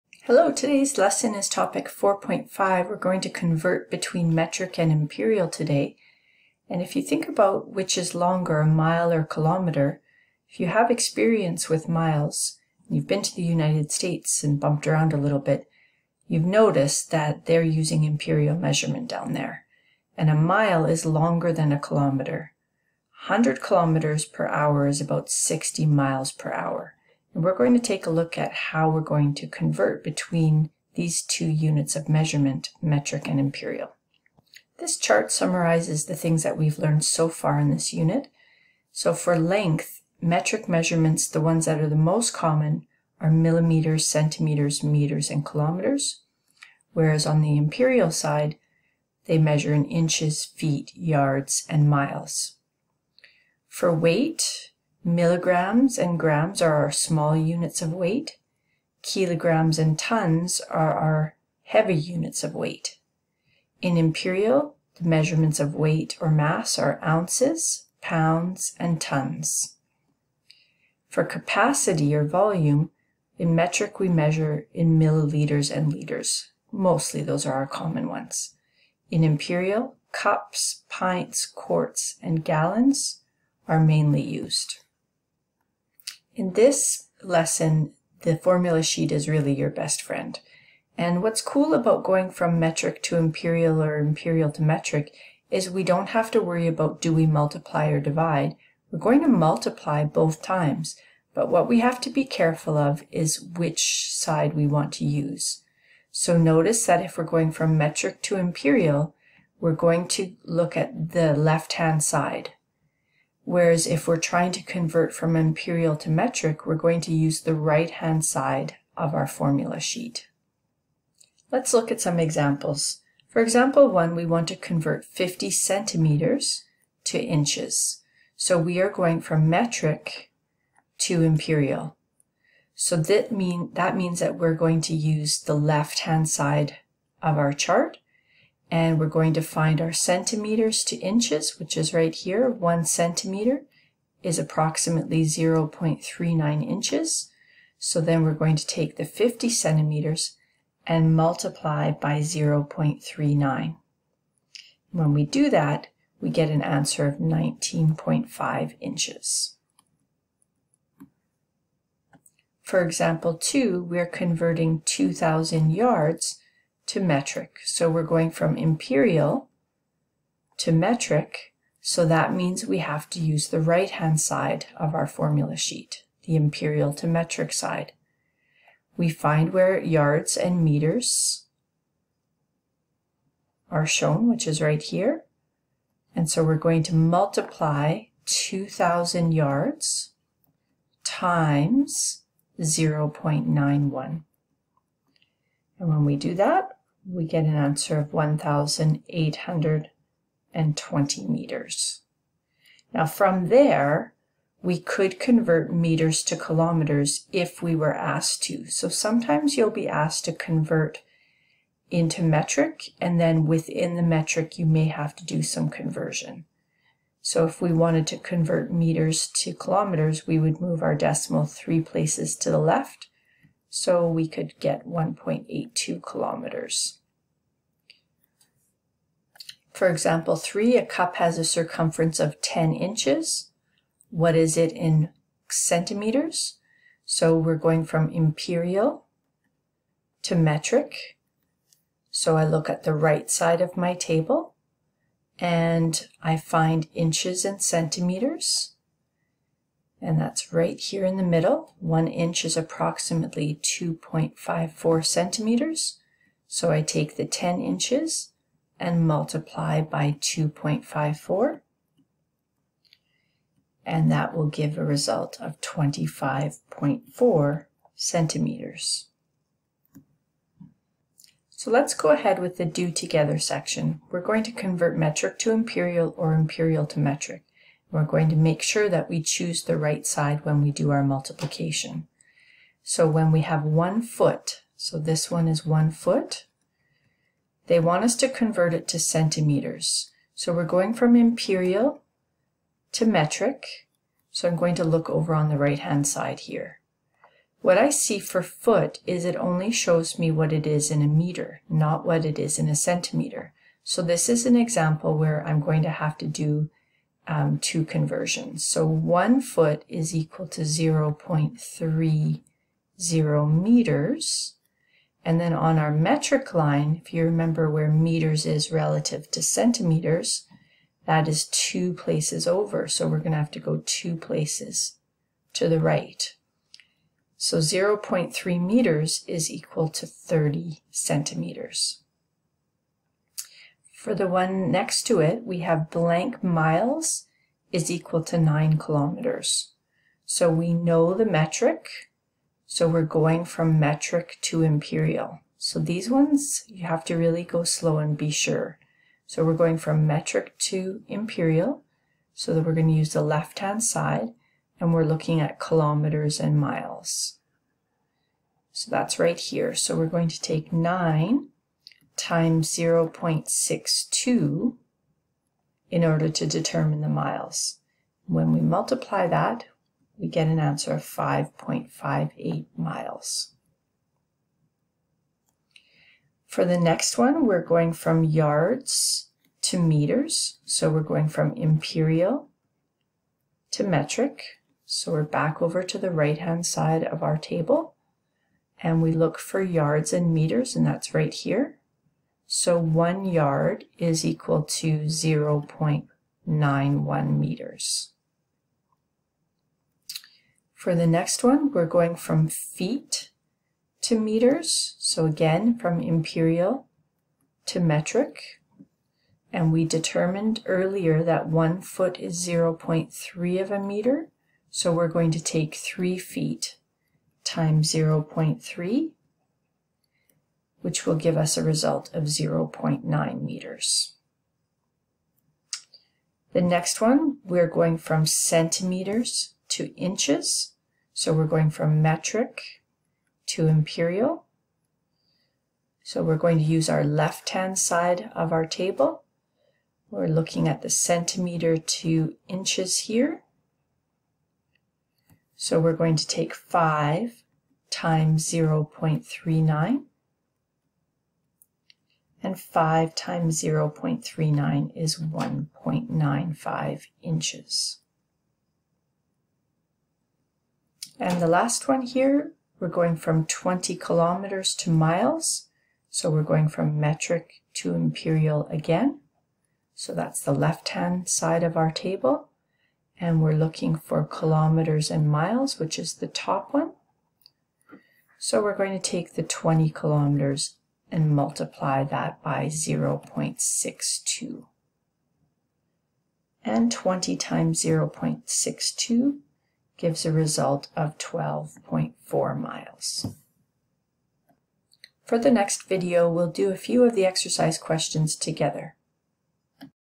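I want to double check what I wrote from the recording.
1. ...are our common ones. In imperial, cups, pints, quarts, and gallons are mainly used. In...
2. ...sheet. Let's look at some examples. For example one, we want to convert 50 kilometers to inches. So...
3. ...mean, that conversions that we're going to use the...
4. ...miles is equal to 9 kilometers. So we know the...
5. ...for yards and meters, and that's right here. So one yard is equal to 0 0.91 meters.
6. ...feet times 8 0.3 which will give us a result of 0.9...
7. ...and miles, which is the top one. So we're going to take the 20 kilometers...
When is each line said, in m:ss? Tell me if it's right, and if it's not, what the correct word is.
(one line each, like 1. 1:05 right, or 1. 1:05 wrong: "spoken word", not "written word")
1. 1:17 right
2. 1:59 wrong: "centimeters", not "kilometers"
3. 2:13 wrong: "means", not "conversions"
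4. 5:36 right
5. 6:29 right
6. 6:56 wrong: "0", not "8"
7. 7:55 right.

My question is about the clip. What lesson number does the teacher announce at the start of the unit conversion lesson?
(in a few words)
4.5.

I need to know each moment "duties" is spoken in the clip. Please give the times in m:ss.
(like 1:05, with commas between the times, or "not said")
not said.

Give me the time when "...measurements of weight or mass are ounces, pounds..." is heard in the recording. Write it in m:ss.
1:05.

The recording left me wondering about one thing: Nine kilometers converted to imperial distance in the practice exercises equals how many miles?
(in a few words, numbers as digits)
5.58 miles.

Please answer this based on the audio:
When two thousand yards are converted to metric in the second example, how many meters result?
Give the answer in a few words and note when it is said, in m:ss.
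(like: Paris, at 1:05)
1,820 meters, at 3:18.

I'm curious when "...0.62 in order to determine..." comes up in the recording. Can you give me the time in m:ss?
6:02.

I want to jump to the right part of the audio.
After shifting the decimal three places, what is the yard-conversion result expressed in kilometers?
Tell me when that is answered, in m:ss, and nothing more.
3:44.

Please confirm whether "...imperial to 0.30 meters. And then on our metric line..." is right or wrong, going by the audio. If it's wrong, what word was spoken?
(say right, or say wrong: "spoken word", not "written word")
wrong: "equal", not "imperial".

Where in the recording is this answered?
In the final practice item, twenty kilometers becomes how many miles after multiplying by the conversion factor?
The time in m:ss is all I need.
8:11.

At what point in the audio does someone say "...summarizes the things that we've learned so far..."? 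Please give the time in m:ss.
0:35.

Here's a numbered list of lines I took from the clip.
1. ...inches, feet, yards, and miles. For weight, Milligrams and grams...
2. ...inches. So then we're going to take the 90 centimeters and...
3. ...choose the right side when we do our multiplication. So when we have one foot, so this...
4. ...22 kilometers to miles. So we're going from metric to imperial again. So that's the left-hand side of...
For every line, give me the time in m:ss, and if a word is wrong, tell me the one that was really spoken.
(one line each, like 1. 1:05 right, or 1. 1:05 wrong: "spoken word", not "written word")
1. 0:49 right
2. 2:26 wrong: "50", not "90"
3. 4:39 right
4. 7:43 wrong: "20", not "22".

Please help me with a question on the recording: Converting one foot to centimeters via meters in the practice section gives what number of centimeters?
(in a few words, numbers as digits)
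30 centimeters.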